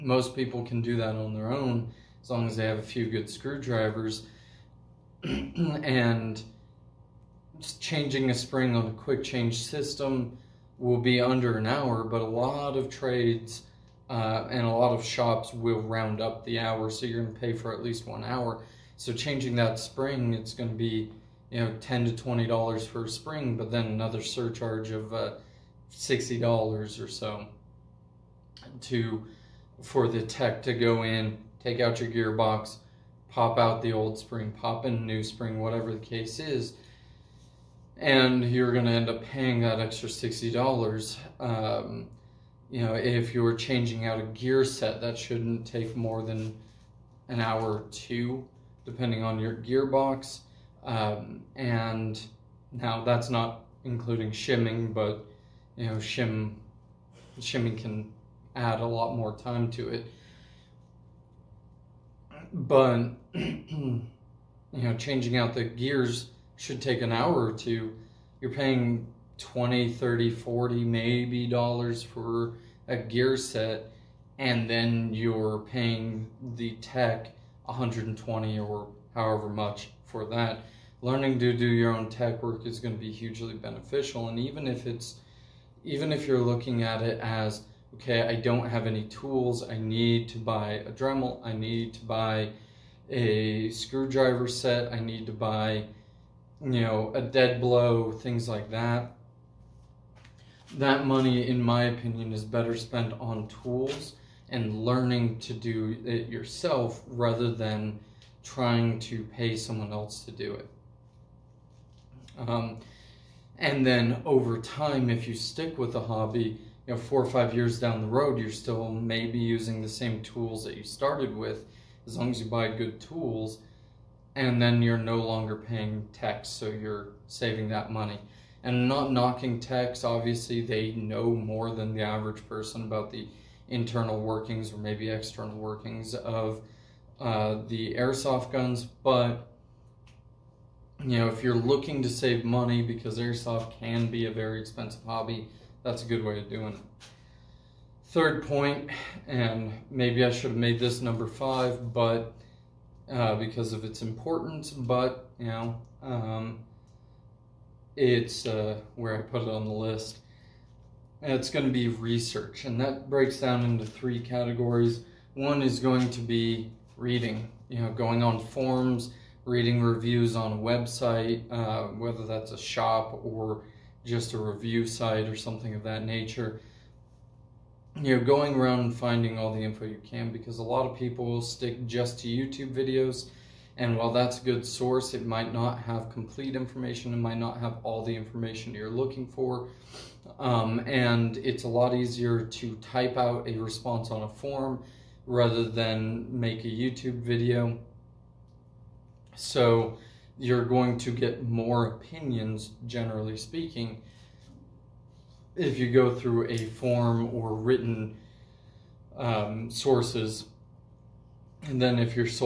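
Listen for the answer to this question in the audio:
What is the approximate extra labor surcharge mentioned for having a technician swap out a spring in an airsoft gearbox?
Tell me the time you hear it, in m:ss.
0:25.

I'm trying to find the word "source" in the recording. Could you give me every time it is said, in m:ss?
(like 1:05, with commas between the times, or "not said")
3:04, 3:29.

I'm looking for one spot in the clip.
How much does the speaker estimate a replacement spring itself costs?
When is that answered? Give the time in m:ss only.
0:21.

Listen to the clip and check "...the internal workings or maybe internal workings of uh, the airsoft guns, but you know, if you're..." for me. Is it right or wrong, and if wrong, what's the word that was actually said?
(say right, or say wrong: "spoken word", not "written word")
wrong: "external", not "internal".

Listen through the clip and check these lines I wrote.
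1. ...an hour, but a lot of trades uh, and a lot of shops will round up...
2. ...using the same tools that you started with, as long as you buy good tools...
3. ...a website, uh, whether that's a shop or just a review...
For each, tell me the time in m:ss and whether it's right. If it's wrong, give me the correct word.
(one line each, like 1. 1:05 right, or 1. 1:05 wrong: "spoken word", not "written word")
1. 0:11 right
2. 1:59 right
3. 2:50 right.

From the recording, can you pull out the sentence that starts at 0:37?
And you're going to end up paying that extra $60.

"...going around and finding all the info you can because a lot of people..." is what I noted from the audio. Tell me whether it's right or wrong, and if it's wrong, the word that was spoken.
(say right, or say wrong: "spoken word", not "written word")
right.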